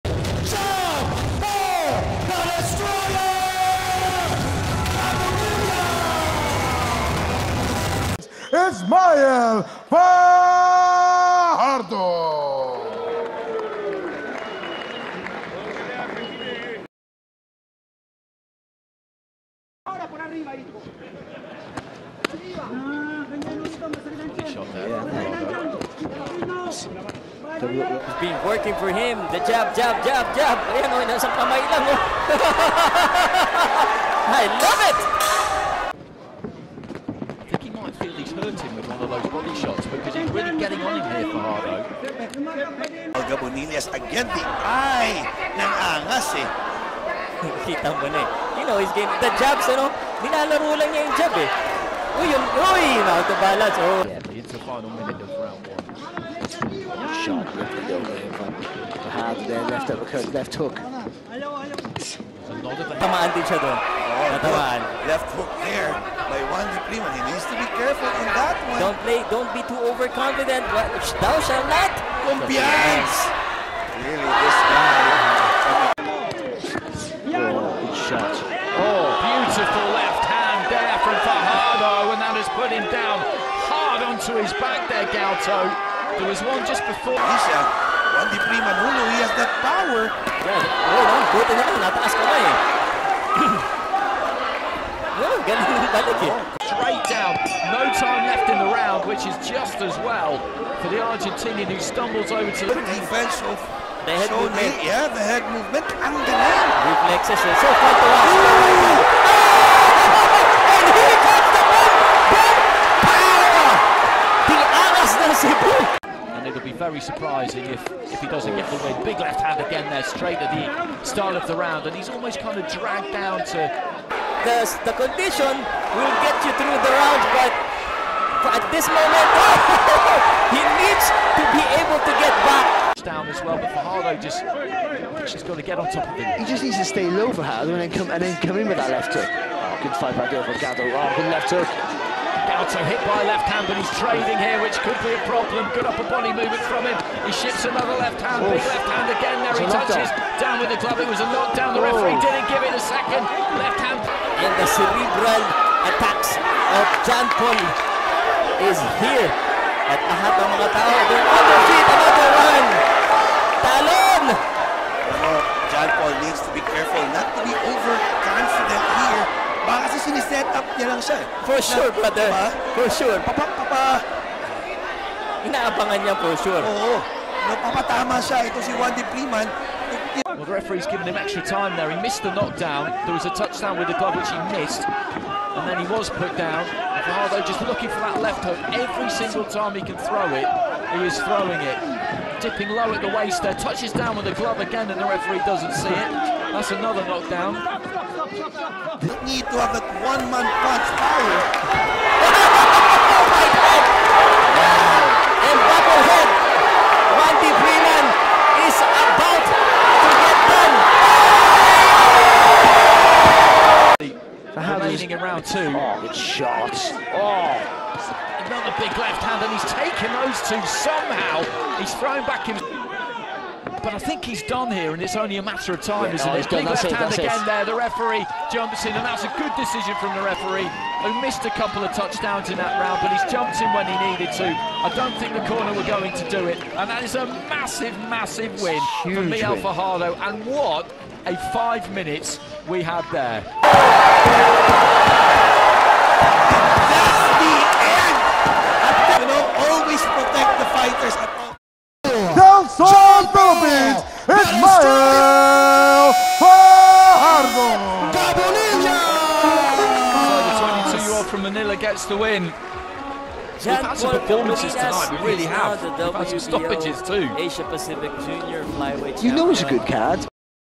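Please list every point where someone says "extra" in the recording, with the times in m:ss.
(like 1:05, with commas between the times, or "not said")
3:01.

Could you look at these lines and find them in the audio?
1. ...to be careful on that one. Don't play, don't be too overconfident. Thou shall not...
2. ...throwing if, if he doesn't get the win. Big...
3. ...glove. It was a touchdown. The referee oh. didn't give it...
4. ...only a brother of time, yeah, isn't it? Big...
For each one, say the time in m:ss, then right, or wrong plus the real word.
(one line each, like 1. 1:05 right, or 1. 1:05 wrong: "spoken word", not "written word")
1. 1:07 right
2. 1:57 wrong: "surprising", not "throwing"
3. 2:30 wrong: "knockdown", not "touchdown"
4. 3:45 wrong: "matter", not "brother".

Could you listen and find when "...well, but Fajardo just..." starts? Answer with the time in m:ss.
2:13.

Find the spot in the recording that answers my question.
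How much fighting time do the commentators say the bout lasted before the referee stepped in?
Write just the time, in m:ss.
4:01.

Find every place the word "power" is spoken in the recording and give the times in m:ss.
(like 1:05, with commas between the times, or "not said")
1:29, 1:55, 3:20.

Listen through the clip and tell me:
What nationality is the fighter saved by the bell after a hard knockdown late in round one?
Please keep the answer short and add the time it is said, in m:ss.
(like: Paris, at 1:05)
Argentinian, at 1:40.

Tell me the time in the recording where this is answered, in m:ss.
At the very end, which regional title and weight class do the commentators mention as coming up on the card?
4:27.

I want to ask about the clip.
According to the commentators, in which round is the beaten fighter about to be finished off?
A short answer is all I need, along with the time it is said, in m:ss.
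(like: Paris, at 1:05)
Round 2, at 3:35.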